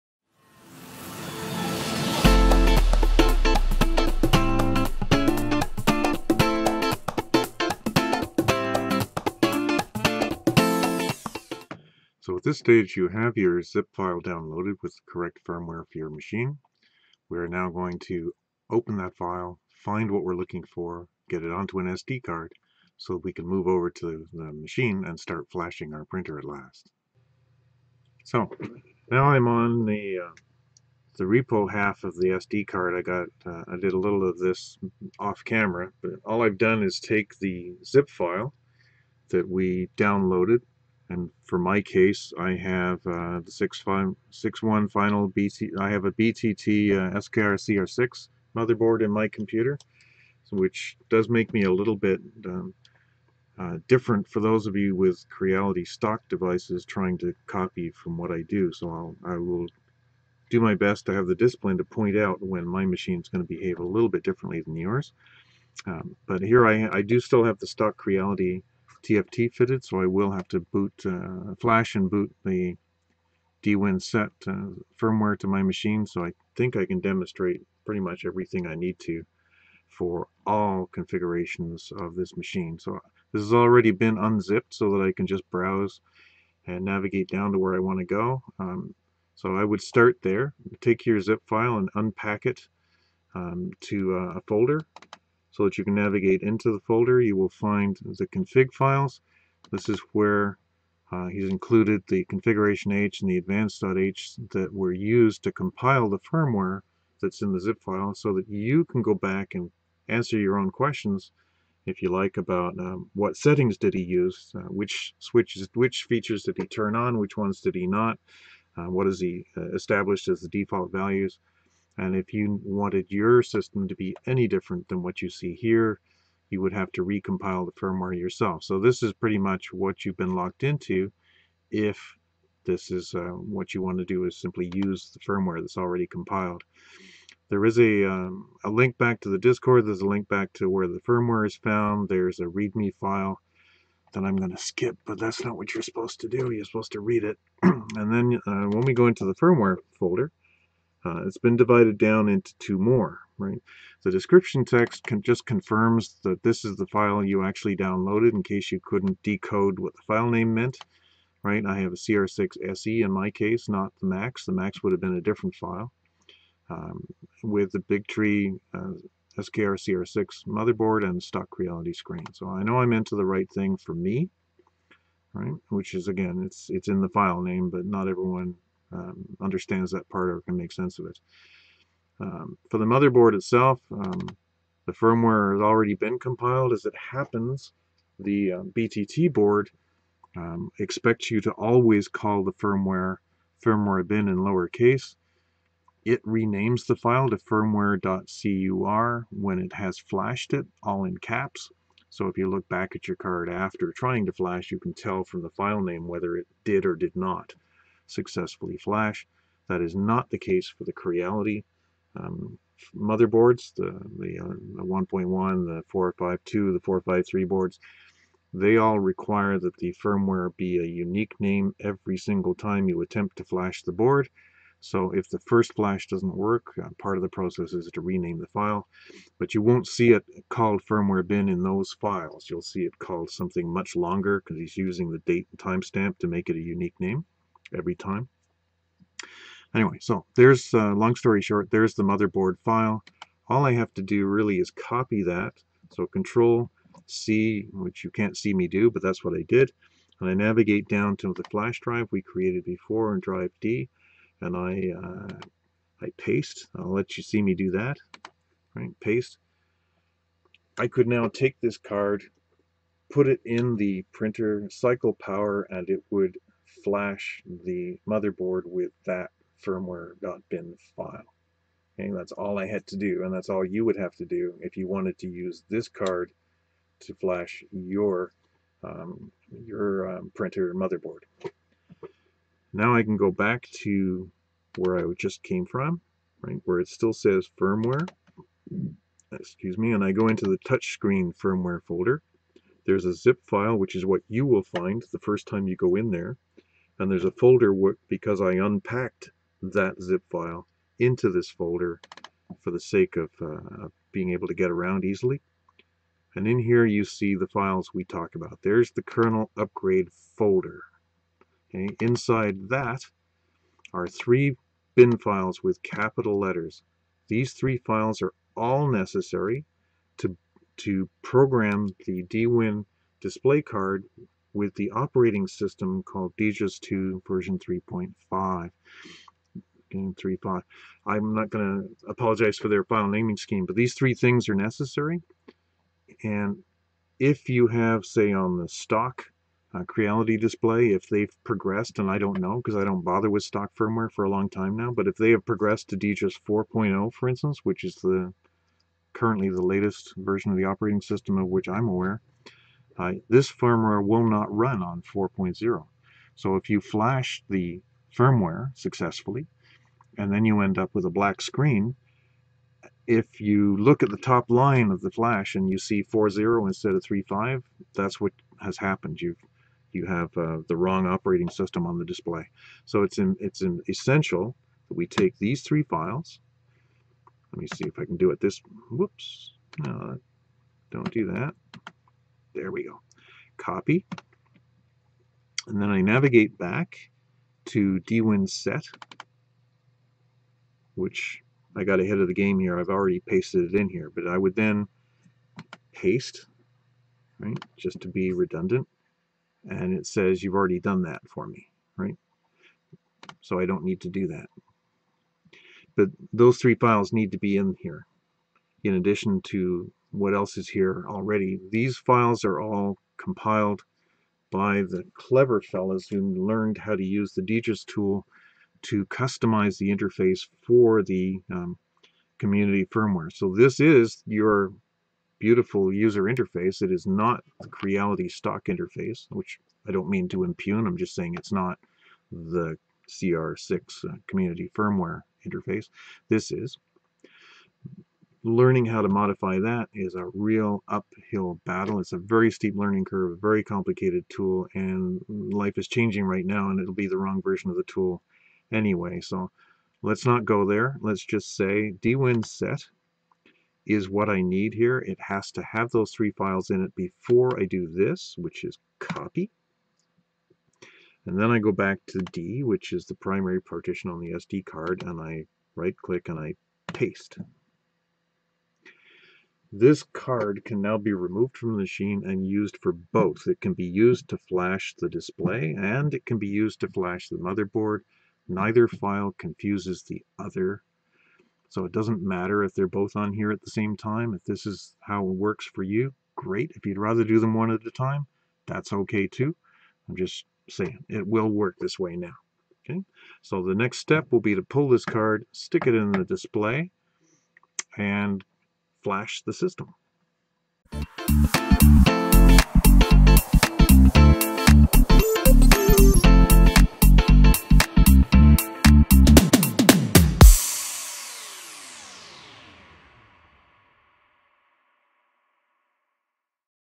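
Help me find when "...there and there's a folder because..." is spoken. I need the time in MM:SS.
04:56.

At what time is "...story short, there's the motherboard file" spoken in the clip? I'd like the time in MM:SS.
04:01.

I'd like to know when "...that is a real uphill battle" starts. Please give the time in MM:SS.
07:19.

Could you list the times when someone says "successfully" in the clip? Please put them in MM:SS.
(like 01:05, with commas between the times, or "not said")
03:28, 05:58.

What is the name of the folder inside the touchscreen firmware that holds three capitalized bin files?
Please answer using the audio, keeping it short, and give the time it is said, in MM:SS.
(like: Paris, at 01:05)
kernel upgrade, at 05:09.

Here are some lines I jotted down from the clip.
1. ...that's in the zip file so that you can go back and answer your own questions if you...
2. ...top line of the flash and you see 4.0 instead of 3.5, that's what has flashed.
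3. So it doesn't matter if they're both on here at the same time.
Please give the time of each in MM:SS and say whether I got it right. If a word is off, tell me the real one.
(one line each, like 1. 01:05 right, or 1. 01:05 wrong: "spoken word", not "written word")
1. 01:47 right
2. 06:04 wrong: "happened", not "flashed"
3. 08:01 right.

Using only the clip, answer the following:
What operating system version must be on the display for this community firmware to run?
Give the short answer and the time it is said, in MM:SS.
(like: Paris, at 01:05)
DGUS 2 version 3.5, at 05:26.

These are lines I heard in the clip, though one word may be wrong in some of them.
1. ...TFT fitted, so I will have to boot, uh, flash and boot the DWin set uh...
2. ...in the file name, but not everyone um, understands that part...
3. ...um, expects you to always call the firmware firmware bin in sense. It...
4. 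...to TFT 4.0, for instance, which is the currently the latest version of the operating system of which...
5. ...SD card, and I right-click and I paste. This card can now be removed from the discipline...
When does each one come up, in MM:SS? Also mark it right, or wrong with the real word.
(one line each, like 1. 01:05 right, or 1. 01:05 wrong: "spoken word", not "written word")
1. 01:09 right
2. 02:56 right
3. 03:10 wrong: "lowercase", not "sense"
4. 05:45 wrong: "DGUS", not "TFT"
5. 07:44 wrong: "machine", not "discipline".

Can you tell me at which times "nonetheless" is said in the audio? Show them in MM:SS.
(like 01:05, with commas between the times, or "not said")
not said.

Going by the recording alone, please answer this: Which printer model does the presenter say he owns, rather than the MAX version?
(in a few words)
CR6 SE.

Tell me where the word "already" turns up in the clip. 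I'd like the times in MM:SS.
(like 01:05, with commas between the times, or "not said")
01:23, 02:15, 03:05, 06:32, 06:40, 06:51.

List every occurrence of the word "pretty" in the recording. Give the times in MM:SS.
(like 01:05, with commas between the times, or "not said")
01:17, 02:09.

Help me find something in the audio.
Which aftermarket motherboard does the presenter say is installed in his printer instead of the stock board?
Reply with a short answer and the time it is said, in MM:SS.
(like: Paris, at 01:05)
BTT SKR-CR6, at 00:46.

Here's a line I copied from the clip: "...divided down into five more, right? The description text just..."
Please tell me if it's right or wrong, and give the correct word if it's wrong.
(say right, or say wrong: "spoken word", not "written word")
wrong: "two", not "five".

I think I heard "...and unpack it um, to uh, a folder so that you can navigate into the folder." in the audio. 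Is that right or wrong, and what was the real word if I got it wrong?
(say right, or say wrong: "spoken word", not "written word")
right.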